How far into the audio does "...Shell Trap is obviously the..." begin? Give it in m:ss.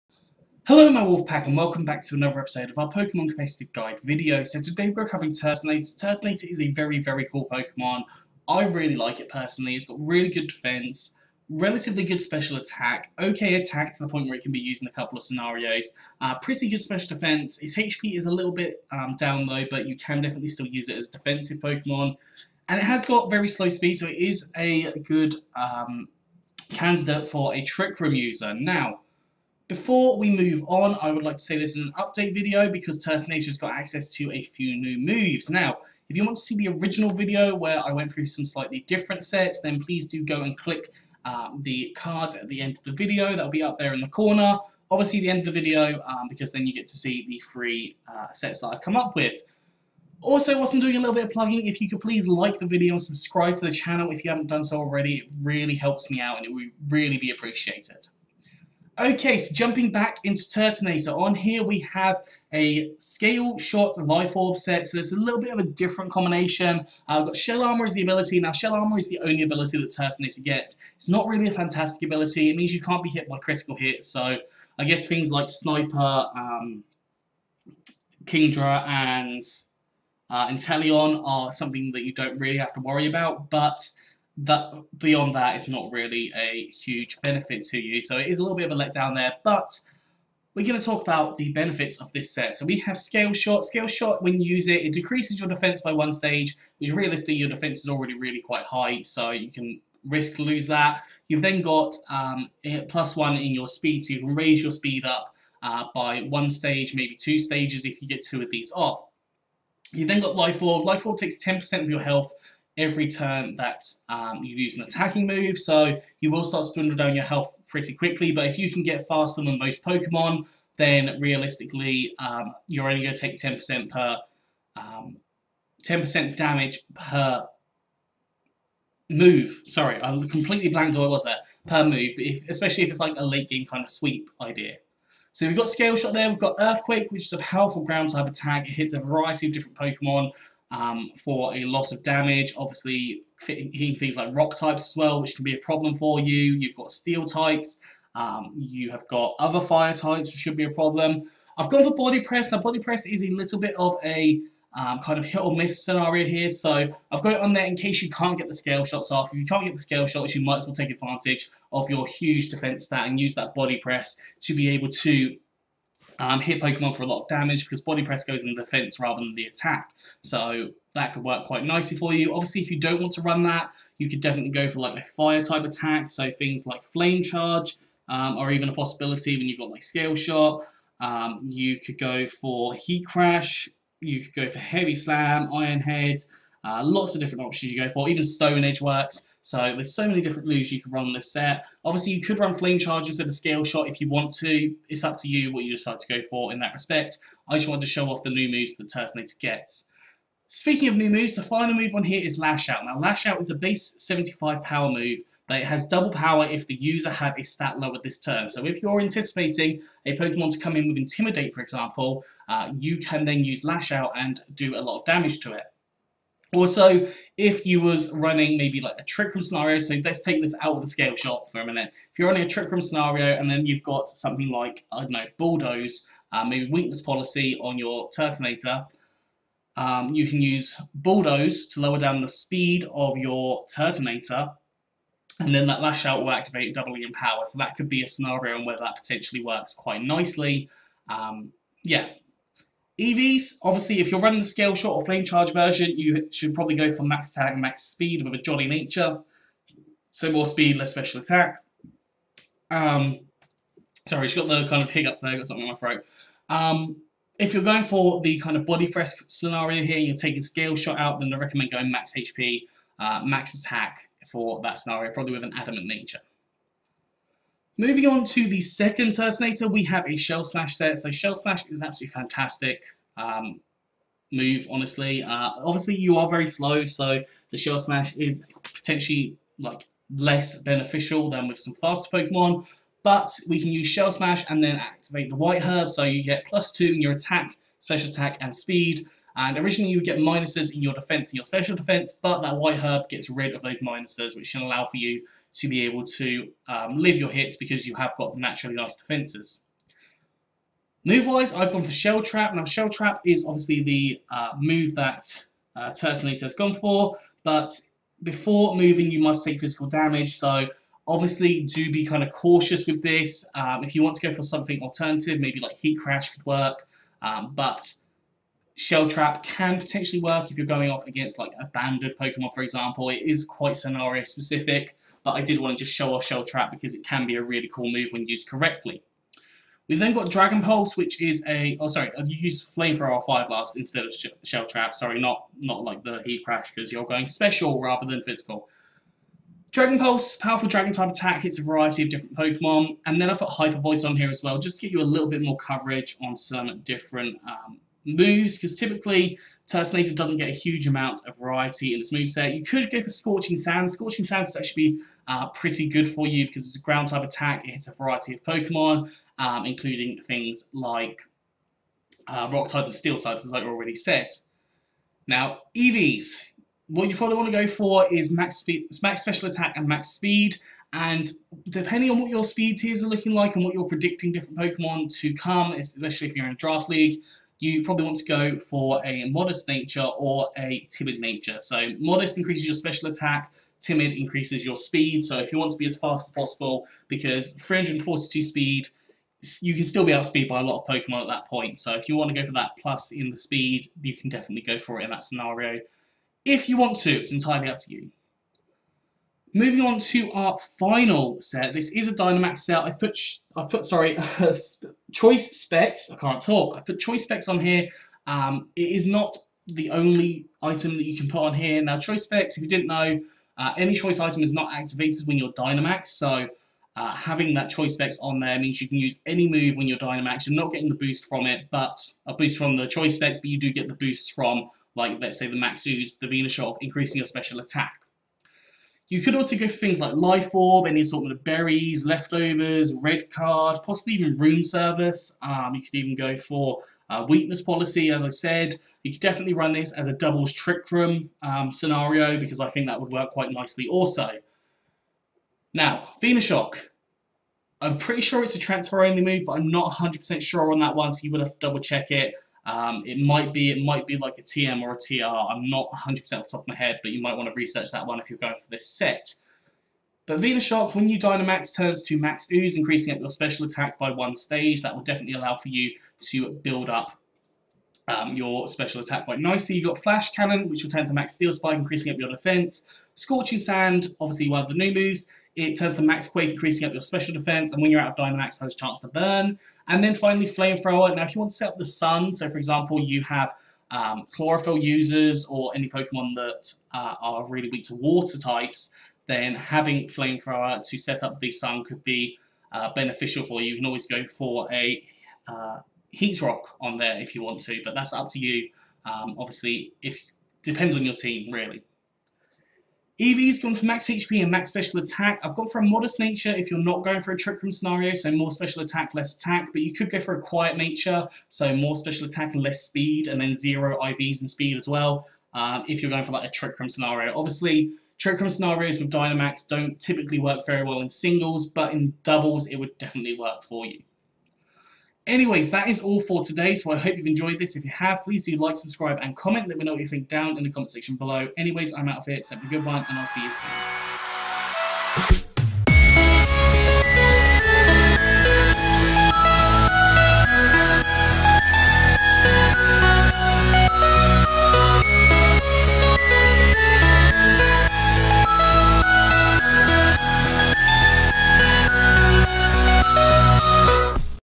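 5:02.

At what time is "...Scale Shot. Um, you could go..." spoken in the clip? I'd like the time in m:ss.
2:59.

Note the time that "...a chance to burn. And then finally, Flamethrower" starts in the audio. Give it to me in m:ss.
7:58.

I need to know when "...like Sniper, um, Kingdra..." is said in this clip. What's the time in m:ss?
1:15.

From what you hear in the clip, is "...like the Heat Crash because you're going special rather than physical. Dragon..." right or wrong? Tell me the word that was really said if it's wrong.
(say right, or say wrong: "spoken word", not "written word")
right.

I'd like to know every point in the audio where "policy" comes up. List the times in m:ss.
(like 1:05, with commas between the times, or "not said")
3:47, 7:17.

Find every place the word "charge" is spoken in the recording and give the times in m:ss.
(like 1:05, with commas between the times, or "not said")
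2:57, 3:12, 4:05.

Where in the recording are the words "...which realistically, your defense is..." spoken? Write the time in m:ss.
1:36.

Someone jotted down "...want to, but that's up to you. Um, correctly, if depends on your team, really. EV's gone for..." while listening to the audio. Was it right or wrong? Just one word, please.
wrong.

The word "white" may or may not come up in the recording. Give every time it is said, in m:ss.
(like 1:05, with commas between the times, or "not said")
4:45, 4:52.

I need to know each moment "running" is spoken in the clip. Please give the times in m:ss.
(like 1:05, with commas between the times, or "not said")
3:38, 3:42, 4:04.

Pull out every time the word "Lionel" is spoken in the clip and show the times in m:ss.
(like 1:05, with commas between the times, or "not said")
not said.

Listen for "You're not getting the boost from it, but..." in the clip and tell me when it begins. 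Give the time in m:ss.
7:00.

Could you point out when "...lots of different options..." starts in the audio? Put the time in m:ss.
3:06.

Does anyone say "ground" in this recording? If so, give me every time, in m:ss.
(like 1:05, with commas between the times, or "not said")
2:17, 5:56.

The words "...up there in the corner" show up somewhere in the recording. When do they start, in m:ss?
0:43.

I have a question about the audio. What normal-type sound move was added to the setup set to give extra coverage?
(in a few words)
Hyper Voice.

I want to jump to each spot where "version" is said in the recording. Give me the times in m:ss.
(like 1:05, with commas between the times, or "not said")
4:05.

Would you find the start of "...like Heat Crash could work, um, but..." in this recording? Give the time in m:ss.
5:15.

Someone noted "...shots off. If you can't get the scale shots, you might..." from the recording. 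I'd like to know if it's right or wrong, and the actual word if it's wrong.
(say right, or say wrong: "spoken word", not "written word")
right.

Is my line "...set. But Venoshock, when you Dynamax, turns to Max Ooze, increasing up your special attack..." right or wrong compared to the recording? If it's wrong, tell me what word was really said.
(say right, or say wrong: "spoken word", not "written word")
right.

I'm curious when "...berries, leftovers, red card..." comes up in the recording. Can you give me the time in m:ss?
7:11.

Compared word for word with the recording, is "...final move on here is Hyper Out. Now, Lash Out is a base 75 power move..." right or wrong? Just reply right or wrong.
wrong.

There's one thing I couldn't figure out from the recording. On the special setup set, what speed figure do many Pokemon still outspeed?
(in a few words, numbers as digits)
342.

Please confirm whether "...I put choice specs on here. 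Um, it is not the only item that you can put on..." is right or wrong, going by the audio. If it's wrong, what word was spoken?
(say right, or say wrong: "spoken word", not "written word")
right.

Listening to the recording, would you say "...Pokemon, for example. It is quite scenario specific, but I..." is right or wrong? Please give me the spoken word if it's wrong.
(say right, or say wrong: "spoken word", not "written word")
right.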